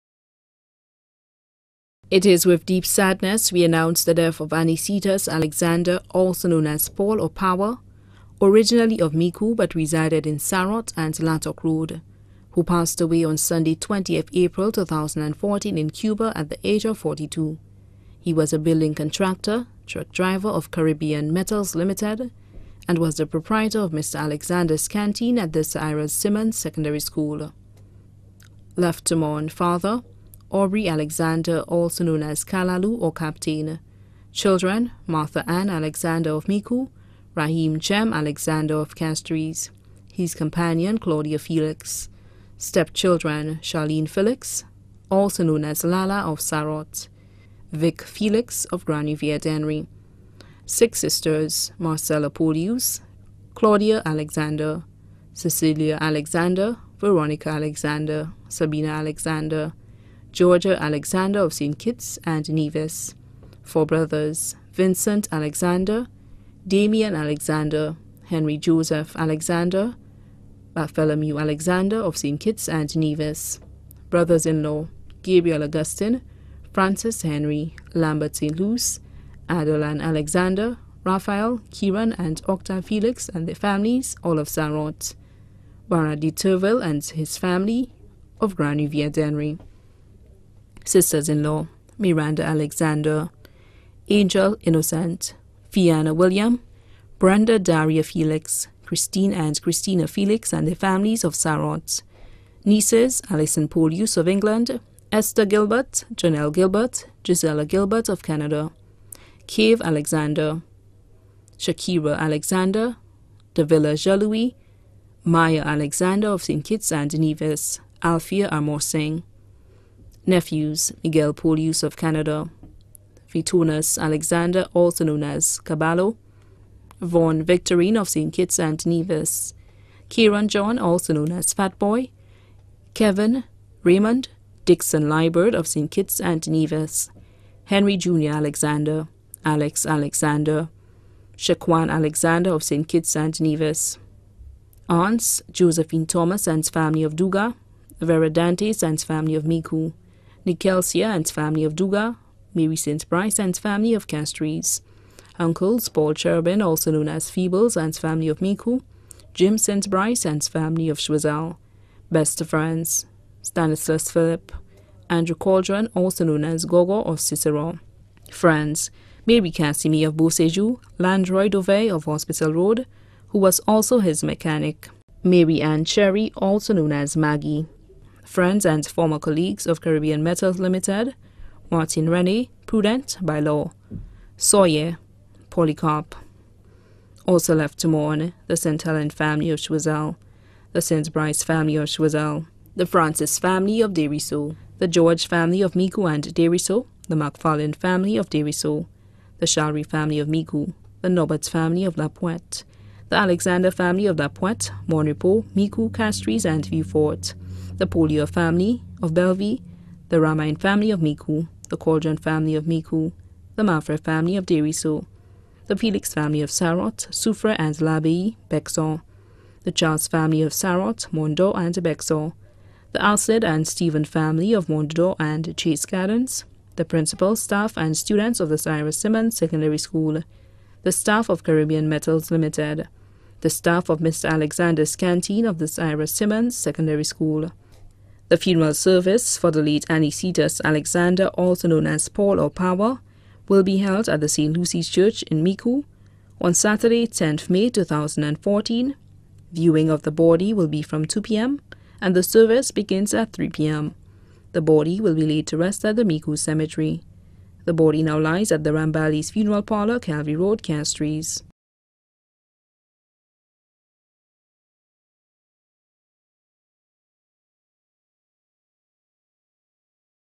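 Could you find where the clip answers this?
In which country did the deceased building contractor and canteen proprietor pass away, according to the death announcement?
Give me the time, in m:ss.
0:15.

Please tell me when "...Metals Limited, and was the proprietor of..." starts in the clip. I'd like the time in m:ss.
0:21.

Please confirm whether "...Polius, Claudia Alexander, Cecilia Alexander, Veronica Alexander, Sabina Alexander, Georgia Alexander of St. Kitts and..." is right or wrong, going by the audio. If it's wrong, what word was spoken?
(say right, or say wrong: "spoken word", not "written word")
right.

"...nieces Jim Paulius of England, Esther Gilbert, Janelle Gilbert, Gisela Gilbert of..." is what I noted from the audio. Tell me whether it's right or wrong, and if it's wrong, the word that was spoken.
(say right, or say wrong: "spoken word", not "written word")
wrong: "Alison", not "Jim".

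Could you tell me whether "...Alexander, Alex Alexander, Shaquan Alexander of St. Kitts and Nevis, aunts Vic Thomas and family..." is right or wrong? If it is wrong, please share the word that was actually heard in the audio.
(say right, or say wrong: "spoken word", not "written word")
wrong: "Josephine", not "Vic".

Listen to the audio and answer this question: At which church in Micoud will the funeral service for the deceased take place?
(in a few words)
St. Lucy's Church.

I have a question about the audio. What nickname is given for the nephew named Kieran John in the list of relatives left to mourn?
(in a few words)
Fat Boy.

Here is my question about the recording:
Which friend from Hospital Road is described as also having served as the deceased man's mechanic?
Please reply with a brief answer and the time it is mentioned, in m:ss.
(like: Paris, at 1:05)
Landroy Dovey, at 2:50.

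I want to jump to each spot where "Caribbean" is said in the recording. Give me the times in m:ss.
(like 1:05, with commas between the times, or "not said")
0:20, 2:59, 3:51.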